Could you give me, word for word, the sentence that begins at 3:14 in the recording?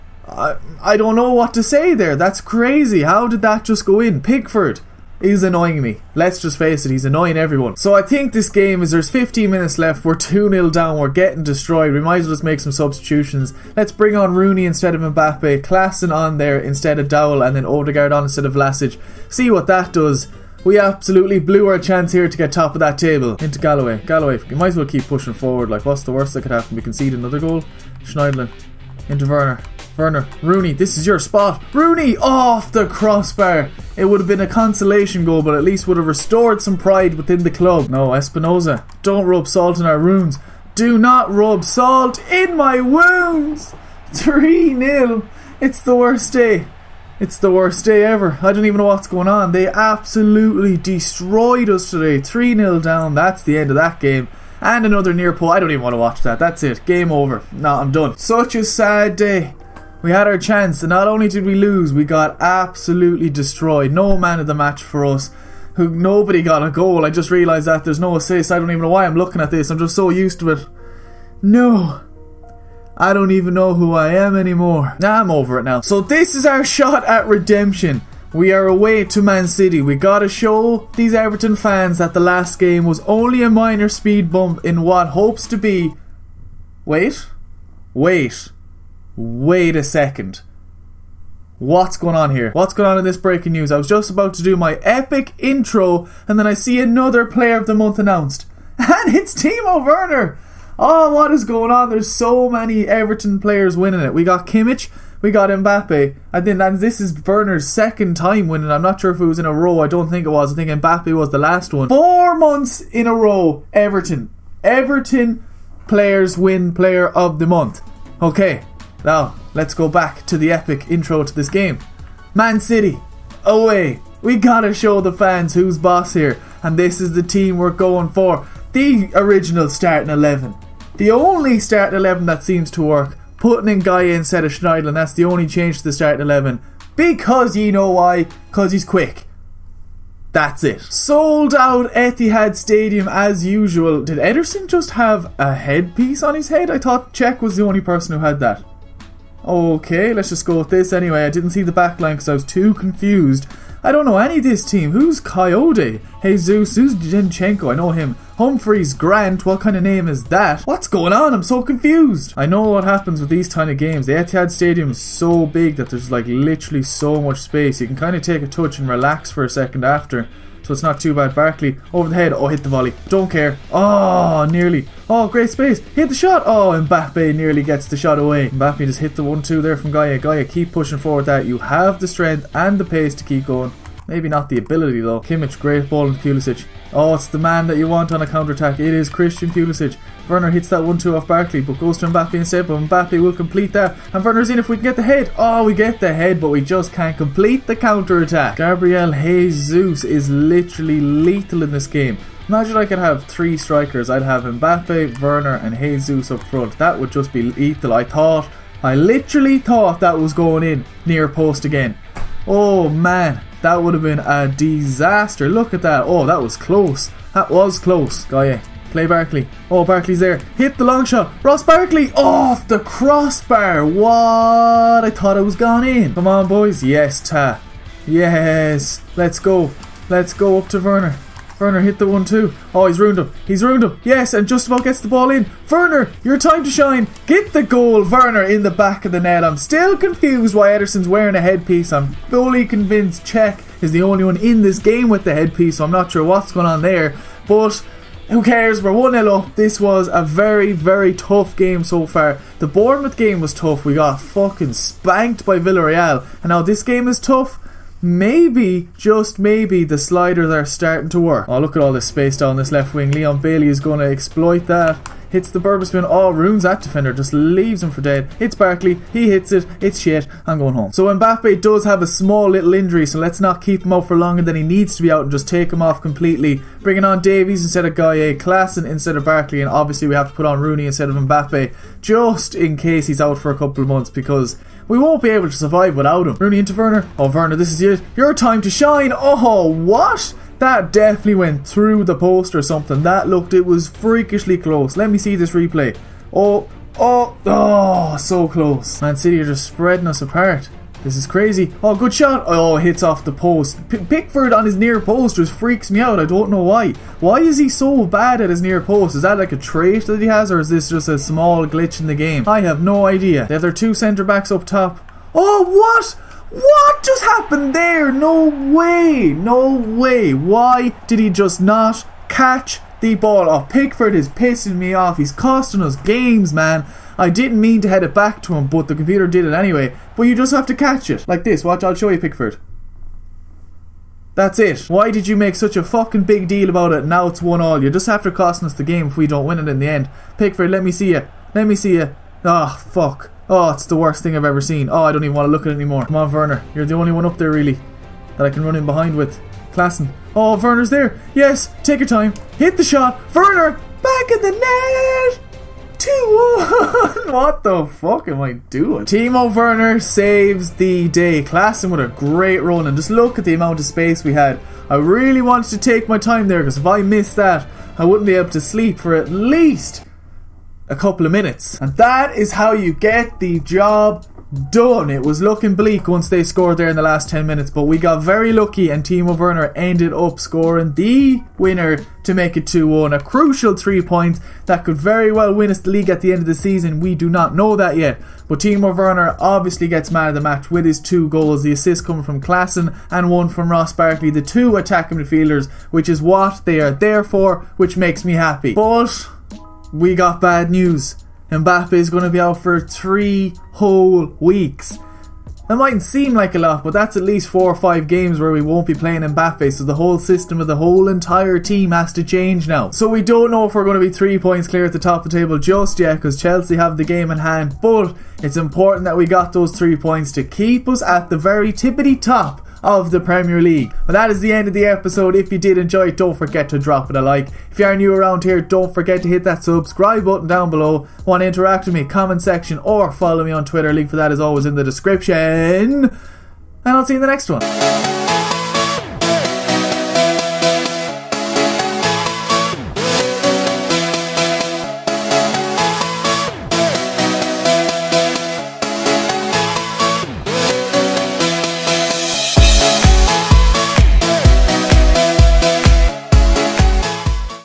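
And Werner's in if we can get the head.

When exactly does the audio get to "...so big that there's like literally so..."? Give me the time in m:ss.
2:45.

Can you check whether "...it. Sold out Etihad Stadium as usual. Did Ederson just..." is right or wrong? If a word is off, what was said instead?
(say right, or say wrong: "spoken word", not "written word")
right.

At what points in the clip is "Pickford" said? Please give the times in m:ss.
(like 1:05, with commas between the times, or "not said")
0:04, 5:04, 5:23, 5:32, 5:40.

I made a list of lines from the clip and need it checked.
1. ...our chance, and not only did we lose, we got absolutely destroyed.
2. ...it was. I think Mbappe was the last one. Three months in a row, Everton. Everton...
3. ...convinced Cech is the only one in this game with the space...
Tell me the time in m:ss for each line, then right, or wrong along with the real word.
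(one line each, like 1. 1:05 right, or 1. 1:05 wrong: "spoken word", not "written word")
1. 1:00 right
2. 1:50 wrong: "Four", not "Three"
3. 4:02 wrong: "headpiece", not "space".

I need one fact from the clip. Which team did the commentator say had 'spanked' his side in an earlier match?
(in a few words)
Villarreal.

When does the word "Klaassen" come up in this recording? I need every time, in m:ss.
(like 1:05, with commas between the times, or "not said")
0:15, 4:38, 5:49, 6:01, 6:32.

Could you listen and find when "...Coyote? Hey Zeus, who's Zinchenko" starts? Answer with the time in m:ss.
2:35.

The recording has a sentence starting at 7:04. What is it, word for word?
Well, that is the end of the episode.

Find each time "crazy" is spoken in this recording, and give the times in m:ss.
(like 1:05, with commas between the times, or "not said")
0:02, 5:01.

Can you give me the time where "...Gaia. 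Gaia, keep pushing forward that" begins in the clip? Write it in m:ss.
2:59.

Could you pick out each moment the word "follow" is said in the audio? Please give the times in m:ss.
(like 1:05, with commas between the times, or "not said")
7:13.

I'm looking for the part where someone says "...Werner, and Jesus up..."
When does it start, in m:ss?
3:25.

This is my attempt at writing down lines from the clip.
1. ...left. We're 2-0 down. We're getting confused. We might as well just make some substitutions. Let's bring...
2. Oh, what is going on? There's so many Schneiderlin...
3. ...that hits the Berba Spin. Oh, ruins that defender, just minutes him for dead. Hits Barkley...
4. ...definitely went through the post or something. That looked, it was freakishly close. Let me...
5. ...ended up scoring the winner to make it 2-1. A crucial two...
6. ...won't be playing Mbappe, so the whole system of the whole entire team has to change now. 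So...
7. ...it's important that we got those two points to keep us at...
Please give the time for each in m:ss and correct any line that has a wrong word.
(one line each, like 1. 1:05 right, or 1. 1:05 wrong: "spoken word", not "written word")
1. 0:09 wrong: "destroyed", not "confused"
2. 1:40 wrong: "Everton", not "Schneiderlin"
3. 4:24 wrong: "leaves", not "minutes"
4. 4:50 right
5. 6:19 wrong: "three", not "two"
6. 6:48 right
7. 6:58 wrong: "three", not "two".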